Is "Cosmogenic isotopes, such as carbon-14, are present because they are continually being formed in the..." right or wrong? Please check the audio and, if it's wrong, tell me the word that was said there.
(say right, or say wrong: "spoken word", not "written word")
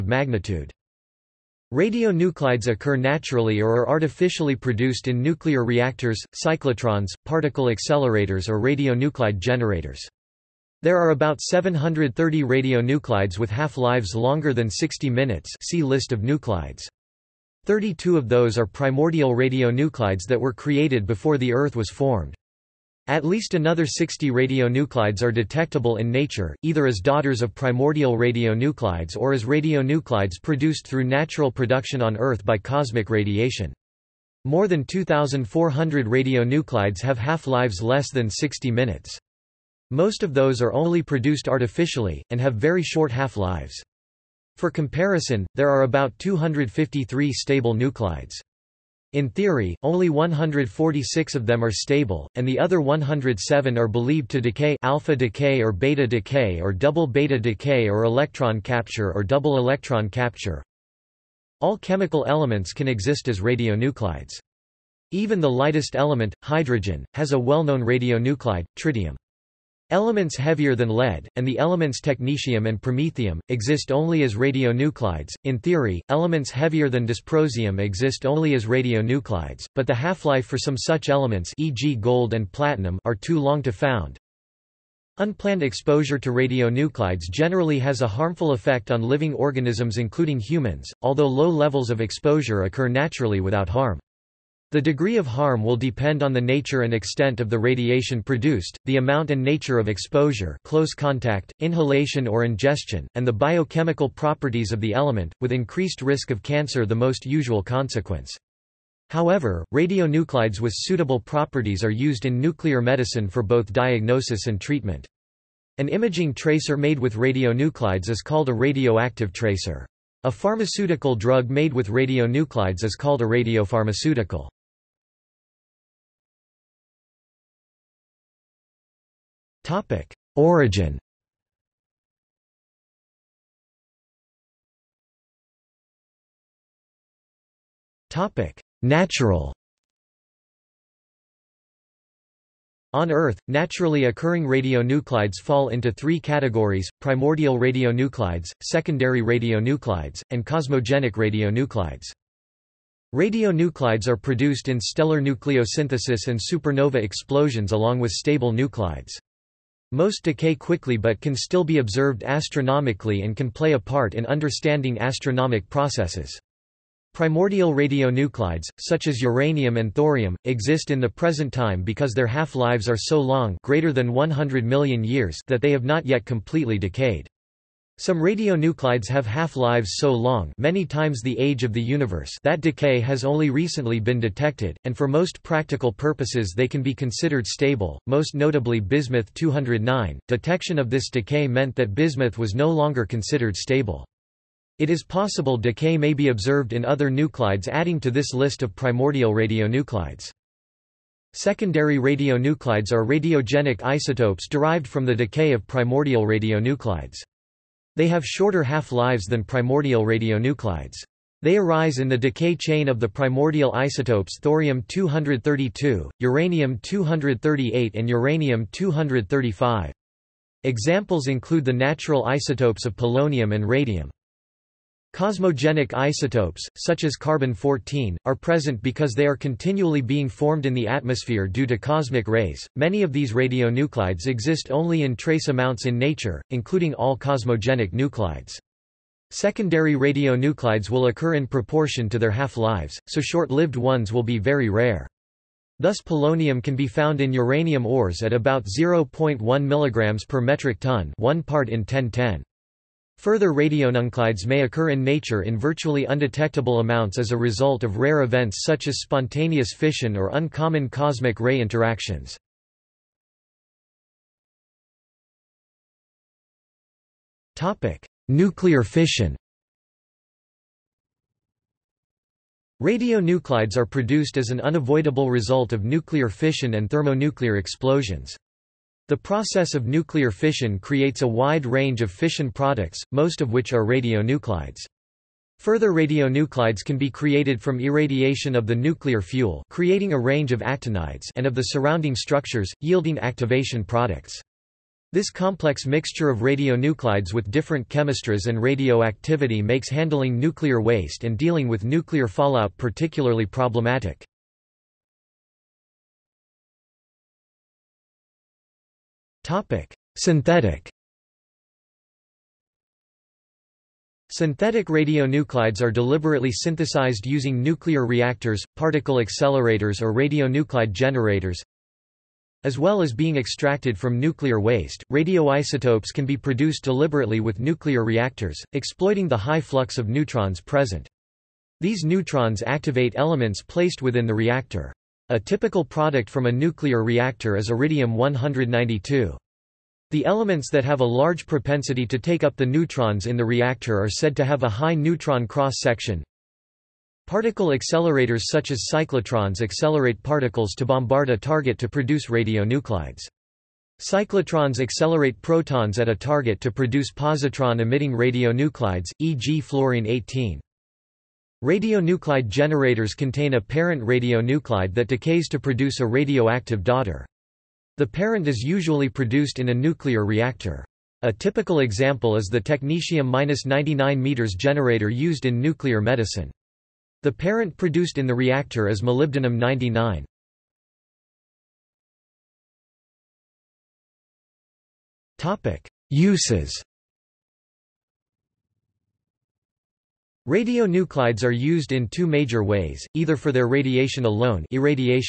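right.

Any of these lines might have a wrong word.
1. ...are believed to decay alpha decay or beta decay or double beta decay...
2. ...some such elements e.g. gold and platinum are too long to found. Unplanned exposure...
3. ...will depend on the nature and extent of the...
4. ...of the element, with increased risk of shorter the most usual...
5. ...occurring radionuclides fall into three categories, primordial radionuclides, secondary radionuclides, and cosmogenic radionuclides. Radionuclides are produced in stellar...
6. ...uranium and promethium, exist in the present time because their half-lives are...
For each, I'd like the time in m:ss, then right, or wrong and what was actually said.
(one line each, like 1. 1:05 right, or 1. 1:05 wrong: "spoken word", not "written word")
1. 0:53 right
2. 1:20 right
3. 1:35 right
4. 1:44 wrong: "cancer", not "shorter"
5. 2:24 right
6. 2:49 wrong: "thorium", not "promethium".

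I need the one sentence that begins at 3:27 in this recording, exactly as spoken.
They have shorter half-lives than primordial radionuclides.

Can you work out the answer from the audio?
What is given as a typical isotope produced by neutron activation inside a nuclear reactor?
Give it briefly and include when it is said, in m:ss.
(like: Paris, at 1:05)
iridium-192, at 5:37.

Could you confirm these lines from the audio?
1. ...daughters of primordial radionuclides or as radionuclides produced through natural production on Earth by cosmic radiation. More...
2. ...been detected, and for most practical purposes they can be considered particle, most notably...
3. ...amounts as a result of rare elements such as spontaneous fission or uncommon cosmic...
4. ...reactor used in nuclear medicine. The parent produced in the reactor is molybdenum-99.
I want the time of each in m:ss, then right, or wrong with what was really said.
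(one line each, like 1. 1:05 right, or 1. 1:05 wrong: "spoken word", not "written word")
1. 0:26 right
2. 3:03 wrong: "stable", not "particle"
3. 4:16 wrong: "events", not "elements"
4. 6:14 wrong: "generator", not "reactor".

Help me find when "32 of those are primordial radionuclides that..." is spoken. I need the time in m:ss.
0:17.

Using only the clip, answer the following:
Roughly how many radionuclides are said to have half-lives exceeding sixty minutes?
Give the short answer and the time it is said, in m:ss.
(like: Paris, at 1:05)
730, at 0:11.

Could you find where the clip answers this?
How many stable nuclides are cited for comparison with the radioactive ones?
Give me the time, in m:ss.
0:46.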